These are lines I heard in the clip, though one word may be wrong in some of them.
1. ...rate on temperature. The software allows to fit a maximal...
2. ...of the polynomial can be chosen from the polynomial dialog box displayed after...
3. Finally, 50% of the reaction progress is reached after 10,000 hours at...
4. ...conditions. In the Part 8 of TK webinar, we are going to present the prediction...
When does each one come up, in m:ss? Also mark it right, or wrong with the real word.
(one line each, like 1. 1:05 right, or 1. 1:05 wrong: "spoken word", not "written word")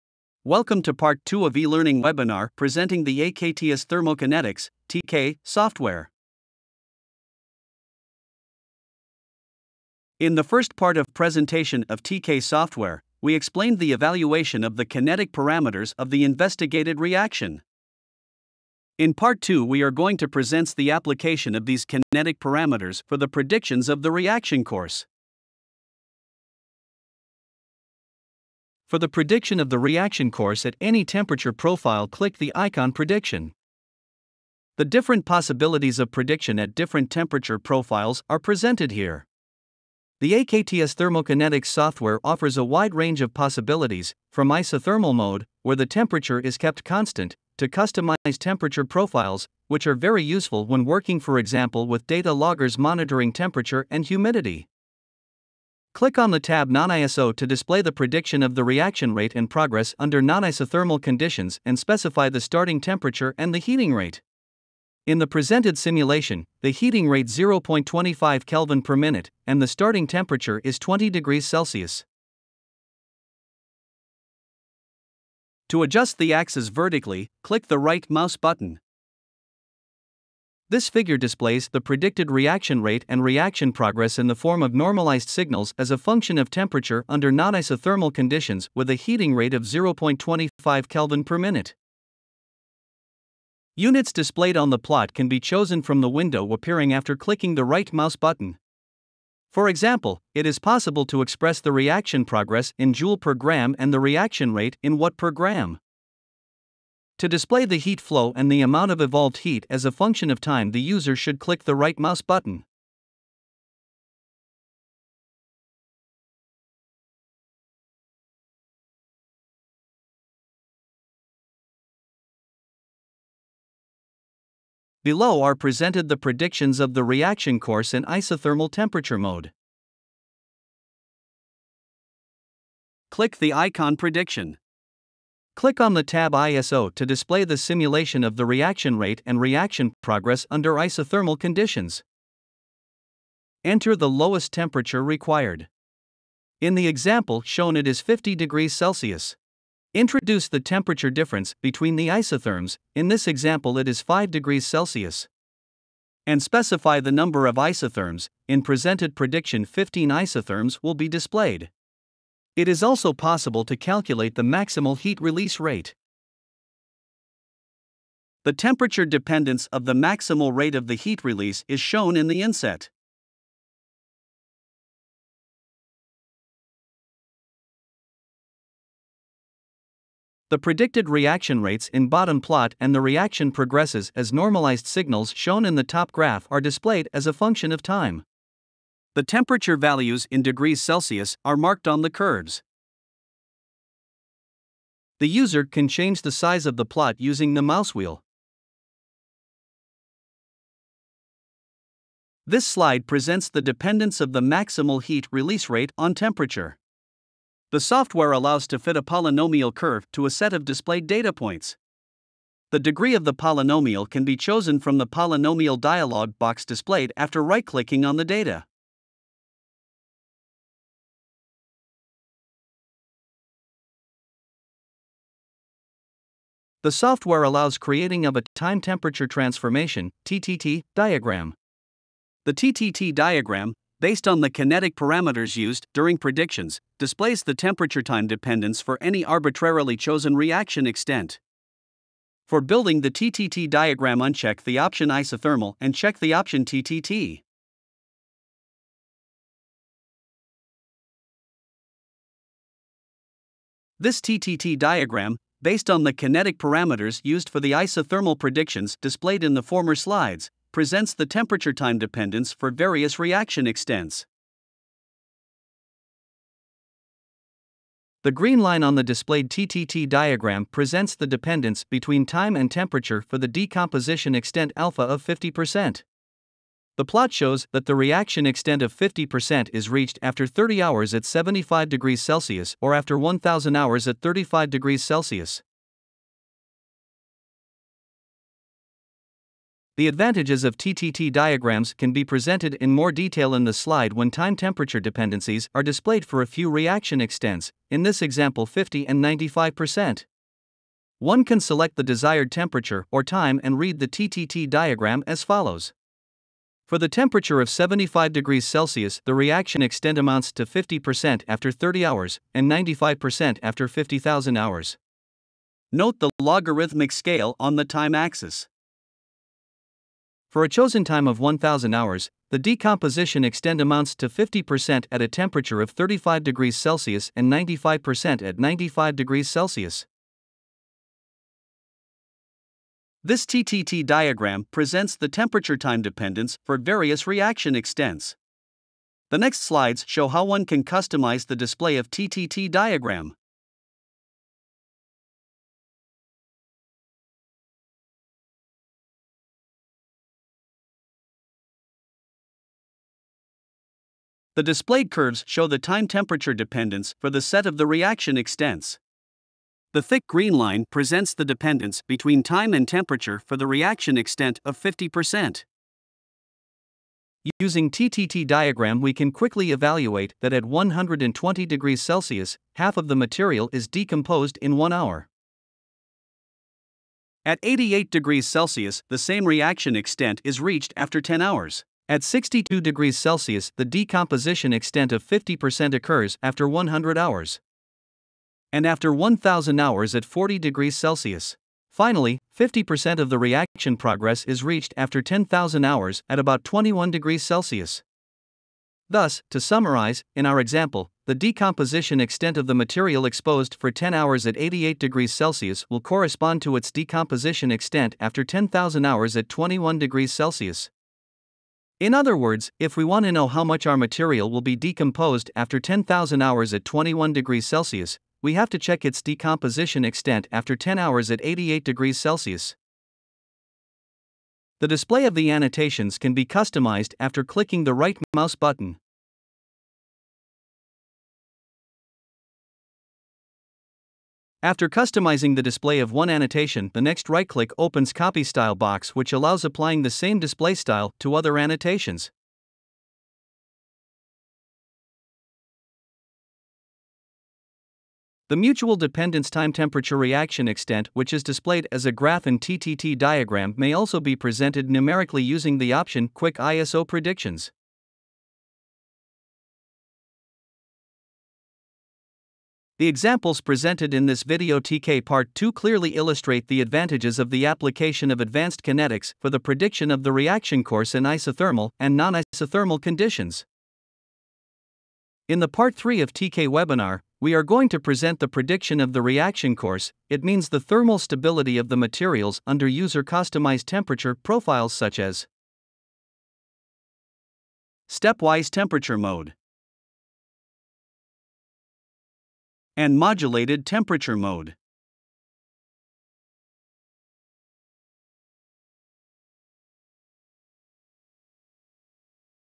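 1. 3:25 wrong: "polynomial", not "maximal"
2. 3:33 right
3. 6:31 right
4. 7:53 wrong: "3", not "8".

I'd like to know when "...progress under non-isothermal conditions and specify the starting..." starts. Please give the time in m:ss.
0:59.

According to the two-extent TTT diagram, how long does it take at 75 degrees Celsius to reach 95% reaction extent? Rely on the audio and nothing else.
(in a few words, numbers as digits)
50,000 hours.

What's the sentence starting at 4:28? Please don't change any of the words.
The green line on the displayed TTT diagram presents the dependence between time and temperature for the decomposition extent alpha of 50%.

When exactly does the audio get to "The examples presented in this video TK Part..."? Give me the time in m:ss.
7:42.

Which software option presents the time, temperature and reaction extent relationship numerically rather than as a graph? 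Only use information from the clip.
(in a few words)
Quick ISO Predictions.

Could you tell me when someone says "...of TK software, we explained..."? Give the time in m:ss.
0:11.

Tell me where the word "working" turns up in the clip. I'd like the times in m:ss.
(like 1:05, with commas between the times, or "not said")
0:50.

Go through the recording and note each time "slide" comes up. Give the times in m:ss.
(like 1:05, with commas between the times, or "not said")
3:22, 4:19, 4:53, 5:39.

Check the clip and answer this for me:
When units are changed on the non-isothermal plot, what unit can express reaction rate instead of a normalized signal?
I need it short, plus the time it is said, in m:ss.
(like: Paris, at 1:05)
watt per gram, at 1:44.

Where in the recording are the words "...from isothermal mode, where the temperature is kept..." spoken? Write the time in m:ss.
0:44.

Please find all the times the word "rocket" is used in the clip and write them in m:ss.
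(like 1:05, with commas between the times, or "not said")
not said.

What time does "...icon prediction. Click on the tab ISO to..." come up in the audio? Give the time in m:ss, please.
2:13.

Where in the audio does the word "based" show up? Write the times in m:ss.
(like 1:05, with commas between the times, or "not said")
3:53, 4:15.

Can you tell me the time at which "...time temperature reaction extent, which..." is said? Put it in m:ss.
7:29.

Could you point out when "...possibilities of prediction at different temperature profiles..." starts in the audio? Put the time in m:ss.
0:35.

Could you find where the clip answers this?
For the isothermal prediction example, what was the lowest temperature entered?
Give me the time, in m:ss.
2:28.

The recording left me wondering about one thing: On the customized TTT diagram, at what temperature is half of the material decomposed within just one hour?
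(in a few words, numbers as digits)
120 °C.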